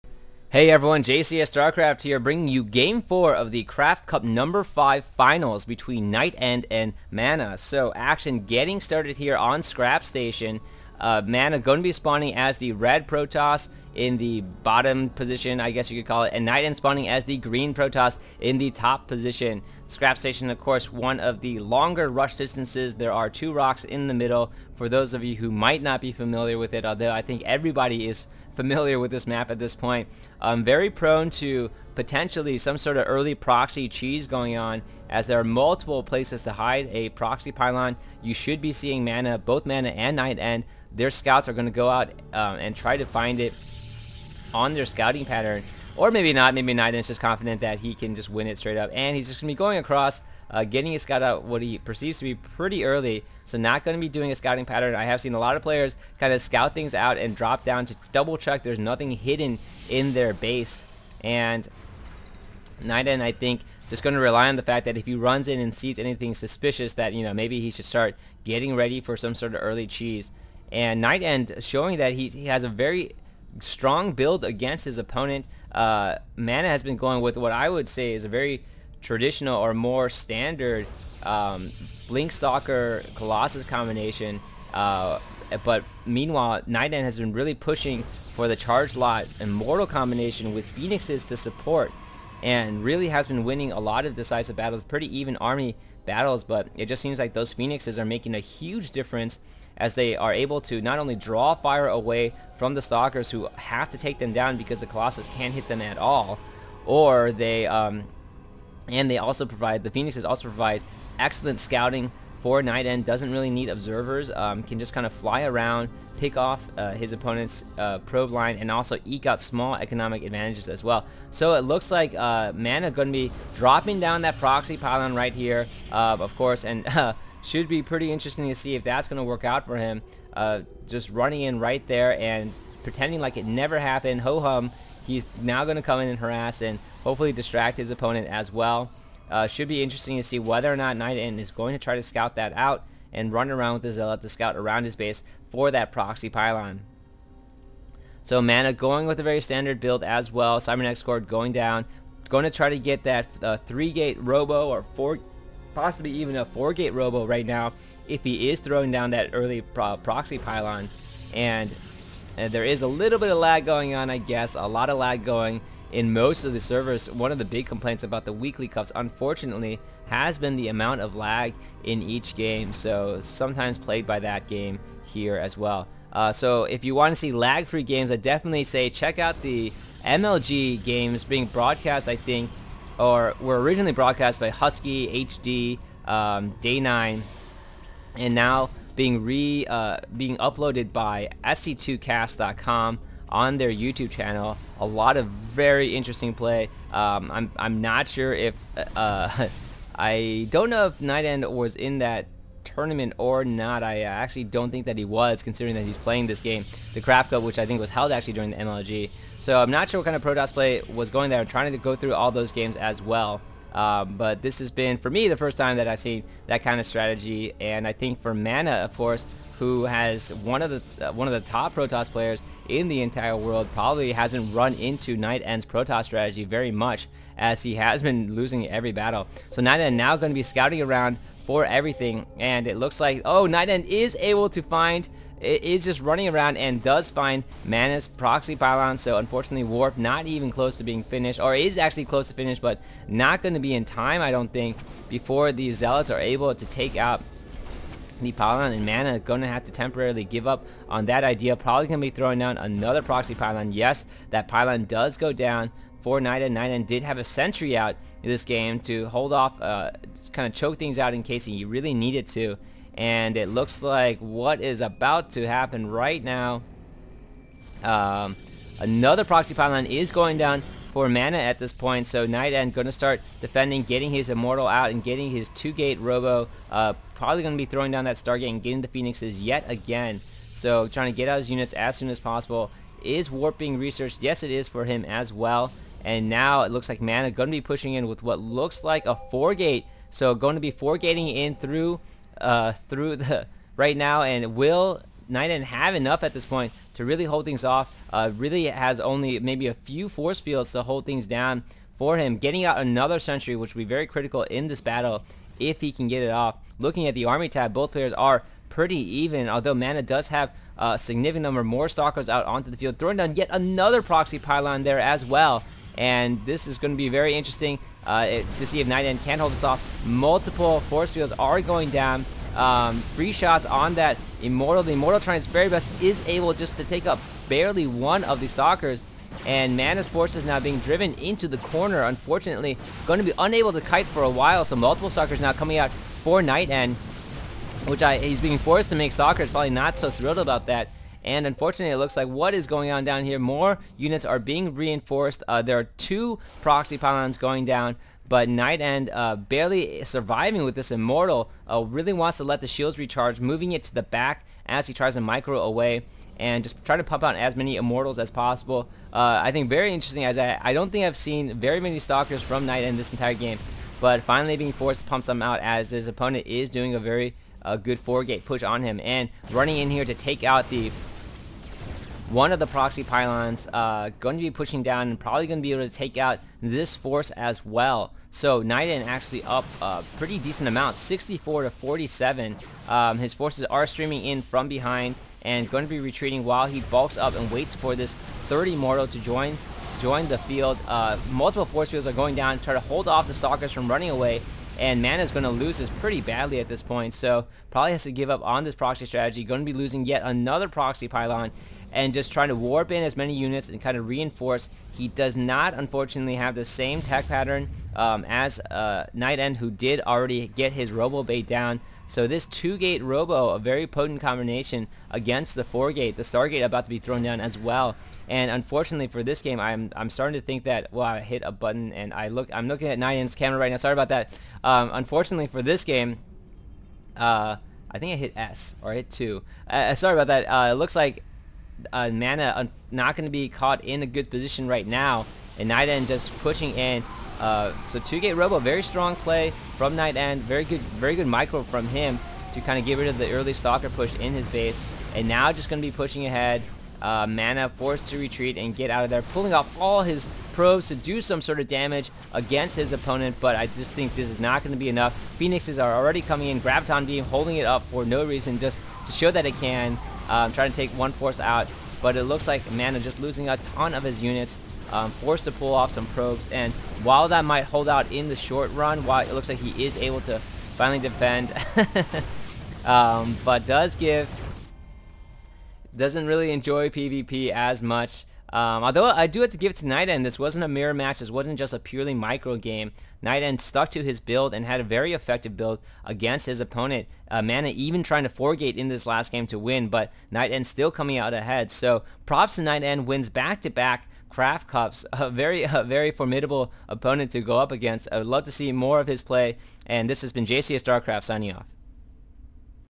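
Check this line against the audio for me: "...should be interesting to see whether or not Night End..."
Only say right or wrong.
right.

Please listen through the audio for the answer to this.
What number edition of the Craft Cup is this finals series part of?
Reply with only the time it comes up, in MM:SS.
00:03.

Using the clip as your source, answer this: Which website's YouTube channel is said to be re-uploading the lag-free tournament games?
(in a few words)
sc2cast.com.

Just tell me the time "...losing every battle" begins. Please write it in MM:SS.
03:48.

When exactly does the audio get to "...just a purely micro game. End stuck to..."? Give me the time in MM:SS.
08:01.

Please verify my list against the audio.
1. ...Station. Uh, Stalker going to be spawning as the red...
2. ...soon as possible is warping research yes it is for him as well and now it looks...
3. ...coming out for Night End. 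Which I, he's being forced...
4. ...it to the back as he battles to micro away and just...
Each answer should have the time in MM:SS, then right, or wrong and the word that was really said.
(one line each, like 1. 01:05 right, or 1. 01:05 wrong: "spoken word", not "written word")
1. 00:10 wrong: "Mana", not "Stalker"
2. 04:41 right
3. 05:35 right
4. 05:53 wrong: "tries", not "battles".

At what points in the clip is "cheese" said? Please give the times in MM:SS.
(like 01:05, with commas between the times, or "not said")
00:33, 01:09.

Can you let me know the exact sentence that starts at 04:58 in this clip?
Uh, really has only maybe a few force fields to hold things down for him.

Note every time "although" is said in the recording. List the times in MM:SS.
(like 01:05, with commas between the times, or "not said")
00:26, 05:09, 07:58.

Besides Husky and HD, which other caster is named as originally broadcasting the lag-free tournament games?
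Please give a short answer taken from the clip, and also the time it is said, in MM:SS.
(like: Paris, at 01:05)
Day9, at 03:06.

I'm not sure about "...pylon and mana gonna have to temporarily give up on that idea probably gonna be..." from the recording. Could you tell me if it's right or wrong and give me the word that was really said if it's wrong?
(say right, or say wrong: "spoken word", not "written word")
right.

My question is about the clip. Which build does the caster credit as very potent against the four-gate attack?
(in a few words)
2-gate Robo.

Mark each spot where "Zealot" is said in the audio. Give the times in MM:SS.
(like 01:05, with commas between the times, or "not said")
02:23, 04:05.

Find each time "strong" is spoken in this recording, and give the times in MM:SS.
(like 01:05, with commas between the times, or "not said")
01:13, 07:18.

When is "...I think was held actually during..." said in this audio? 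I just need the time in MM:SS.
03:27.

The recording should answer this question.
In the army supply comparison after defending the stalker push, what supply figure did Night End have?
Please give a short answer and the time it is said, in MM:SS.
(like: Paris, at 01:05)
64, at 06:20.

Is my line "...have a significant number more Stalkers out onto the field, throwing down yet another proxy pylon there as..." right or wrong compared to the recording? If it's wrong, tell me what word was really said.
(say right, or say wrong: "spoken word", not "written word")
right.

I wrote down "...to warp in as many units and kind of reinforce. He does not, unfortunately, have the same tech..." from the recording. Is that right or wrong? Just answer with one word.
right.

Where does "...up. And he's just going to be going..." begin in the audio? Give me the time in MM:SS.
00:48.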